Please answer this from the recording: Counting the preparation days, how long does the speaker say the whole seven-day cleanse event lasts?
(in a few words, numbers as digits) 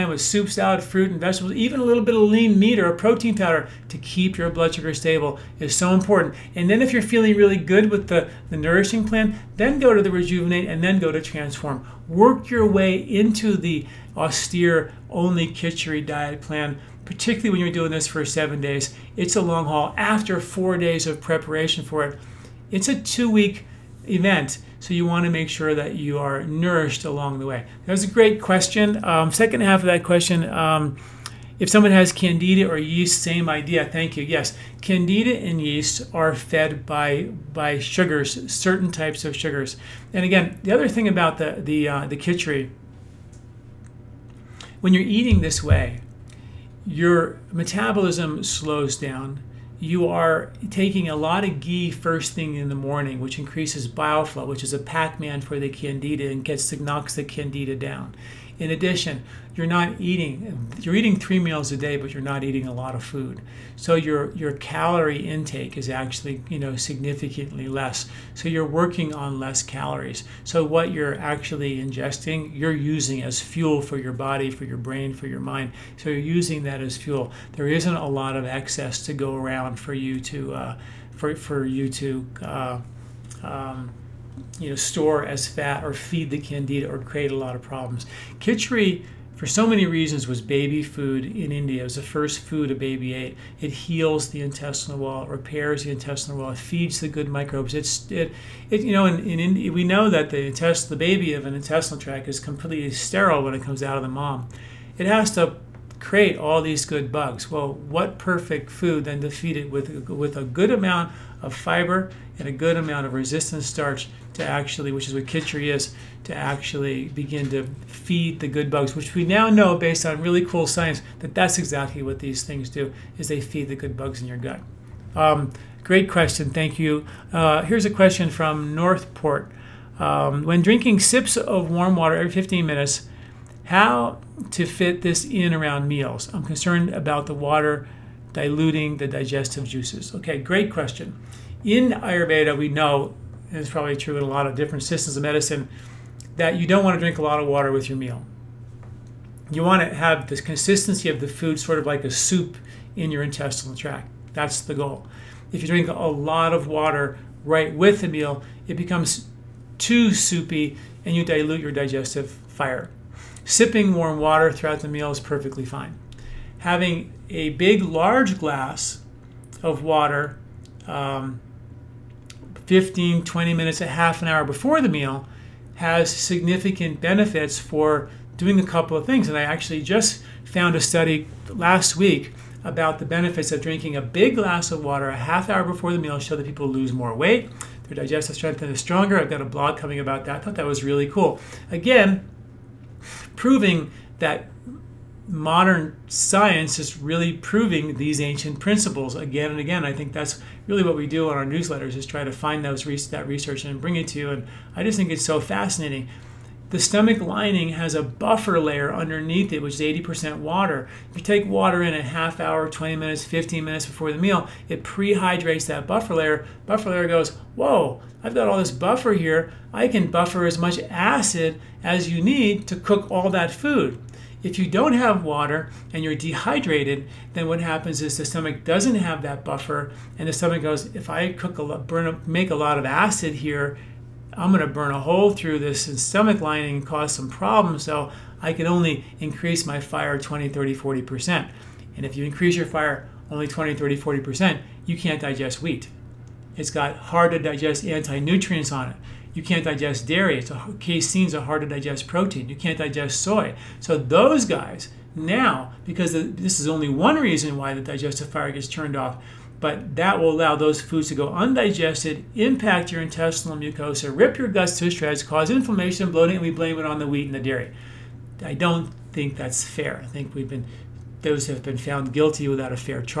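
2 weeks.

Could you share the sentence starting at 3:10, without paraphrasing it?
I thought that was really cool.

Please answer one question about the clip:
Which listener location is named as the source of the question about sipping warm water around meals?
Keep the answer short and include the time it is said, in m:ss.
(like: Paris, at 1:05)
Northport, at 2:08.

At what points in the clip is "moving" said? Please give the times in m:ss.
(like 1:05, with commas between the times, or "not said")
not said.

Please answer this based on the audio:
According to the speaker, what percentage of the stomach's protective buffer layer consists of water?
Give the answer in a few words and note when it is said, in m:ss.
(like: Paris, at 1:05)
80%, at 3:29.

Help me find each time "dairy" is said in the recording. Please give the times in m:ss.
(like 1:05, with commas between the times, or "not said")
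4:10, 4:27.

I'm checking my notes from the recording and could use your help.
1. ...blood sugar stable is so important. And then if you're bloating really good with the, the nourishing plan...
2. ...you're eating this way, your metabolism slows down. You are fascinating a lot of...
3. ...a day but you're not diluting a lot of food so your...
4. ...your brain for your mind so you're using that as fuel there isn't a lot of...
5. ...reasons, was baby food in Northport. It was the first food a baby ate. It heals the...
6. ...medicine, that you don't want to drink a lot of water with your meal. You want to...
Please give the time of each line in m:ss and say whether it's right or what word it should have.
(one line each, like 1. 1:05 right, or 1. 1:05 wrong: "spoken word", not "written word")
1. 0:04 wrong: "feeling", not "bloating"
2. 0:44 wrong: "taking", not "fascinating"
3. 1:01 wrong: "eating", not "diluting"
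4. 1:14 right
5. 1:29 wrong: "India", not "Northport"
6. 2:25 right.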